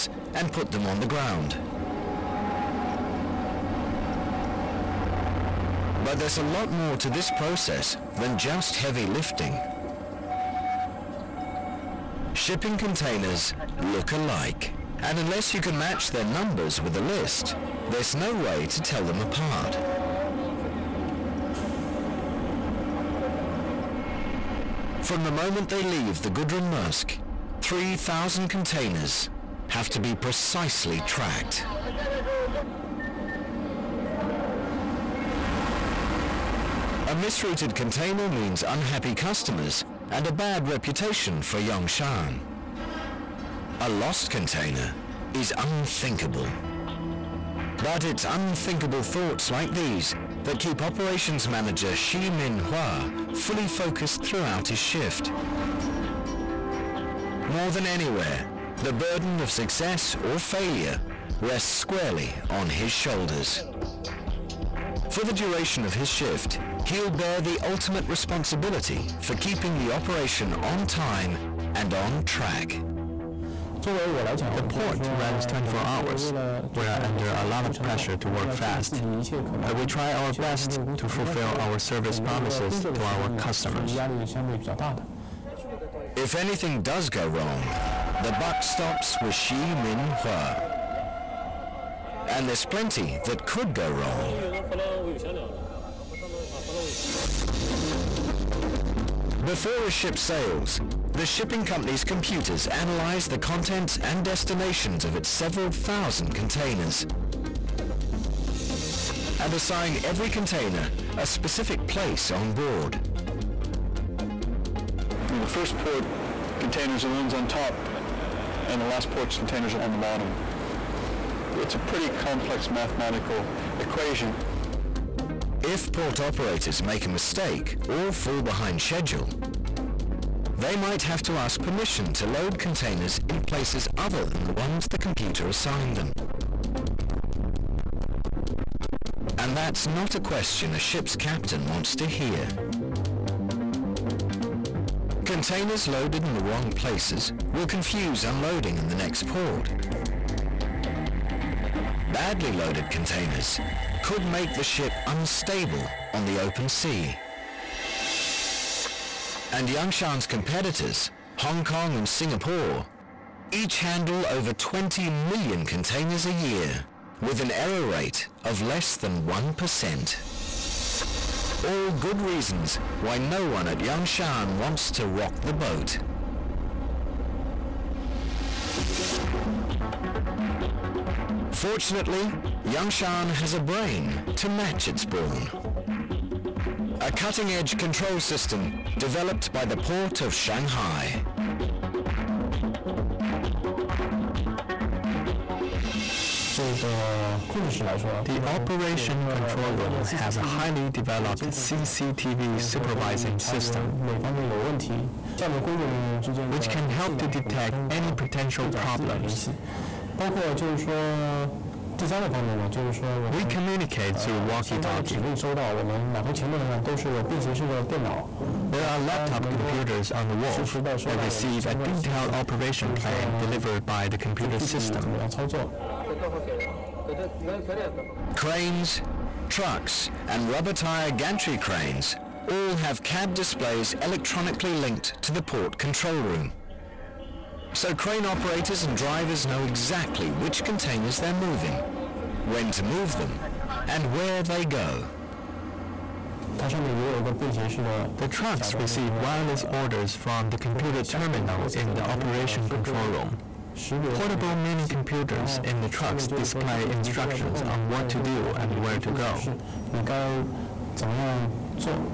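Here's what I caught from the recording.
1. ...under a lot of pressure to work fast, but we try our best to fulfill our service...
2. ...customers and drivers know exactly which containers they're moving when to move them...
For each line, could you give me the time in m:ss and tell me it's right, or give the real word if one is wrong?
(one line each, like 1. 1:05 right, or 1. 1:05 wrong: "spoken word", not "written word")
1. 1:17 right
2. 3:58 wrong: "operators", not "customers".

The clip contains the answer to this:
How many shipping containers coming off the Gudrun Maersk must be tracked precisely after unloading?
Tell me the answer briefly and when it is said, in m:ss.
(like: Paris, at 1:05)
3,000, at 0:27.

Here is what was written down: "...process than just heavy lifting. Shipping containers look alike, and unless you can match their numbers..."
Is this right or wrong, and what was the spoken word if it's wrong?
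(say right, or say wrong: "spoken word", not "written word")
right.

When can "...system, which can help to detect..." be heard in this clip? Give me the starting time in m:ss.
3:23.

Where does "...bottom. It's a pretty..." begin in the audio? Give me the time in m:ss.
1:59.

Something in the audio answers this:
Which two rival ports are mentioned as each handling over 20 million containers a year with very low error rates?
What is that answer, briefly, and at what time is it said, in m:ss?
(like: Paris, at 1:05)
Hong Kong and Singapore, at 2:41.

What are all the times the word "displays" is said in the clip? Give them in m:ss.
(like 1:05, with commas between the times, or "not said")
3:53, 4:16.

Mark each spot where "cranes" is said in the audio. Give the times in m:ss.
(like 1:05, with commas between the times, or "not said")
3:51, 3:57.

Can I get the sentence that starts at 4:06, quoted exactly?
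The trucks receive wireless orders from the computer terminal in the operation control room.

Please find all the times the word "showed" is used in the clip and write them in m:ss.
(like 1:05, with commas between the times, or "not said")
not said.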